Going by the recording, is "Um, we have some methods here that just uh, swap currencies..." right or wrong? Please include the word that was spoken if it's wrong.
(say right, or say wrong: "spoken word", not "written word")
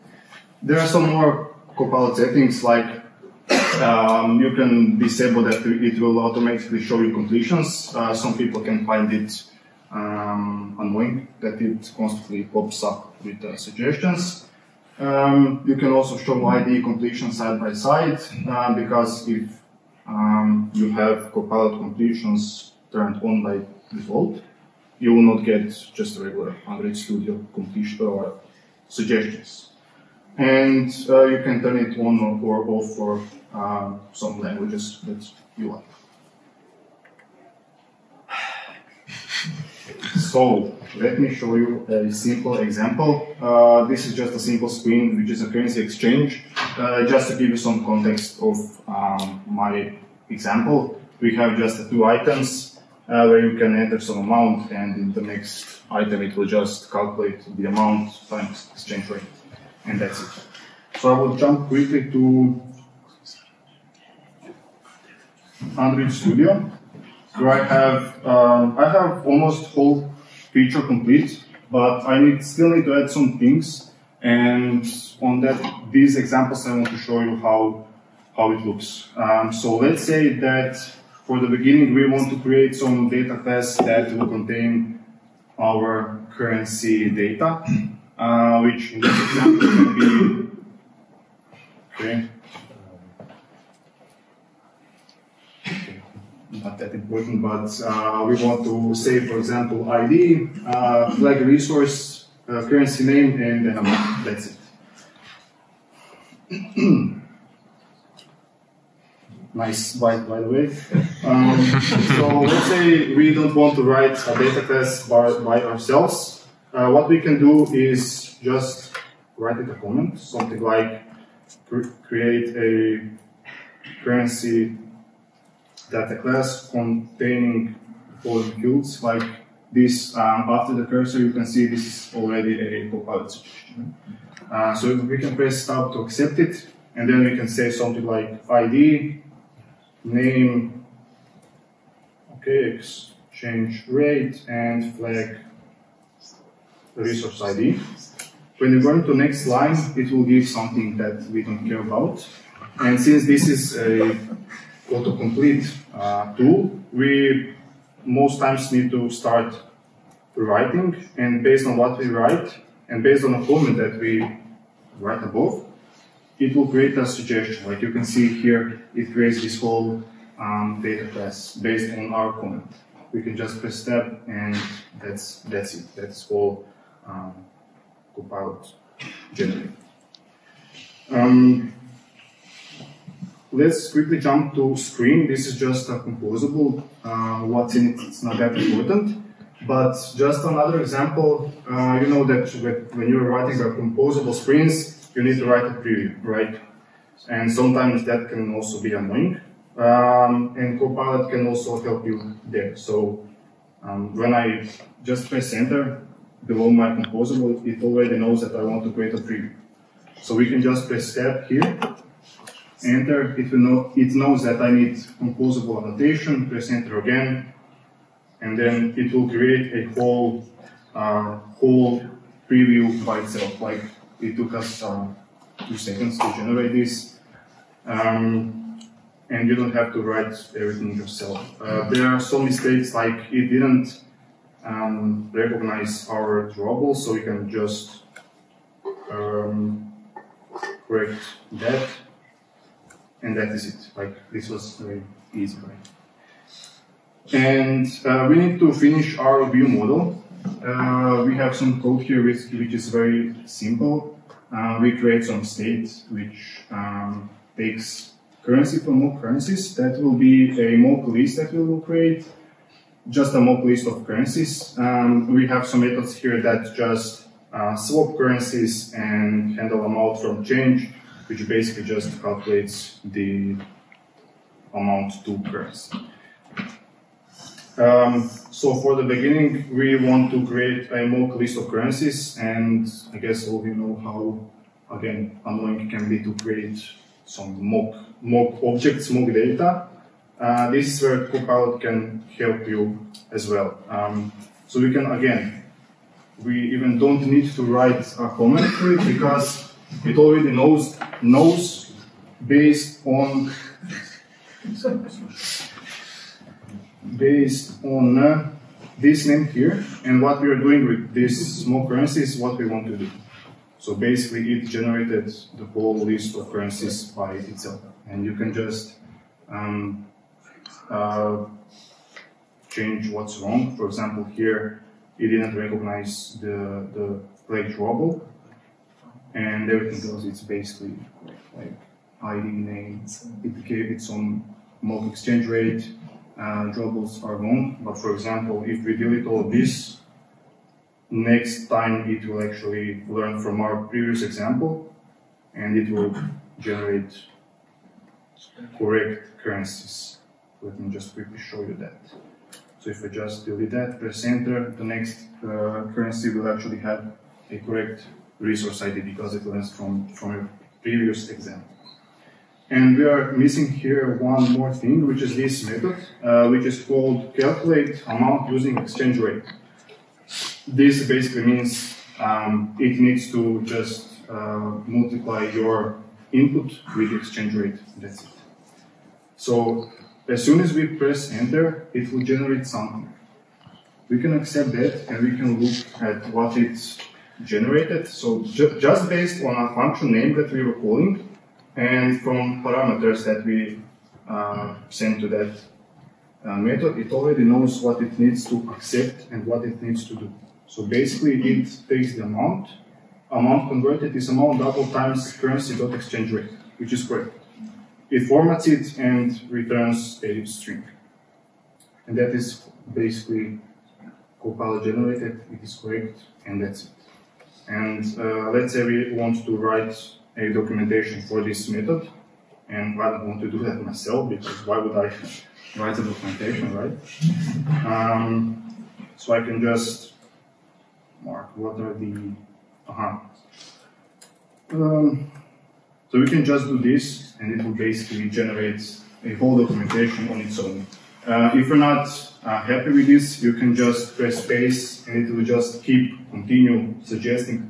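right.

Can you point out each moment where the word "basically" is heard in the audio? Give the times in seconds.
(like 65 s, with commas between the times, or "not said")
271 s, 313 s, 330 s, 371 s, 400 s, 412 s, 437 s.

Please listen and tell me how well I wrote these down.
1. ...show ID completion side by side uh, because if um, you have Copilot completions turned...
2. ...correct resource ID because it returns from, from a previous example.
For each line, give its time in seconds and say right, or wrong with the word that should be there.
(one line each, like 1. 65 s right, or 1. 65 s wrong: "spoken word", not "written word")
1. 16 s right
2. 357 s wrong: "learns", not "returns".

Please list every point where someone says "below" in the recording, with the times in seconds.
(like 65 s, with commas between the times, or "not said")
206 s.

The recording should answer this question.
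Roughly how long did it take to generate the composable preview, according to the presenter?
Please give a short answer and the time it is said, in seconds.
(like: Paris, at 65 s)
2 seconds, at 225 s.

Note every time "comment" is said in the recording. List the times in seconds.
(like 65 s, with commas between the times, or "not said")
119 s, 163 s, 172 s, 298 s.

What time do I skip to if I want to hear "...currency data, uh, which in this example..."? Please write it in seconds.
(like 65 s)
86 s.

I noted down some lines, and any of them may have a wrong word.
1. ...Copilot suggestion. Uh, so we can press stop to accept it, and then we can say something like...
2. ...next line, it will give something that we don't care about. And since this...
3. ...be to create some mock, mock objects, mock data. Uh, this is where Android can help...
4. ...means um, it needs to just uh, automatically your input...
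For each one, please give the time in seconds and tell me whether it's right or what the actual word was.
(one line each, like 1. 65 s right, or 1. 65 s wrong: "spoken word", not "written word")
1. 132 s right
2. 149 s right
3. 286 s wrong: "Copilot", not "Android"
4. 371 s wrong: "multiply", not "automatically".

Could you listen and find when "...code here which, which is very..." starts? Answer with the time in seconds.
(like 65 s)
251 s.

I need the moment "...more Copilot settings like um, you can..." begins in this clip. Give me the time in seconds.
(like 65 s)
1 s.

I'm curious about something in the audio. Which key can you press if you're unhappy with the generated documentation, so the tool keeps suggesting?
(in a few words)
Space.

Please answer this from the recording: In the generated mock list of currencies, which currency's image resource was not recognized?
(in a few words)
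Ruble.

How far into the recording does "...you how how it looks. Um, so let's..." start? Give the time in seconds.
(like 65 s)
77 s.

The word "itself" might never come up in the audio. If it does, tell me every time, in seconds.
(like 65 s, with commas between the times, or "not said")
223 s, 317 s.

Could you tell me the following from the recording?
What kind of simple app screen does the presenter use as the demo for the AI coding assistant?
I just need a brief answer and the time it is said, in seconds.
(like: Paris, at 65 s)
Currency exchange, at 45 s.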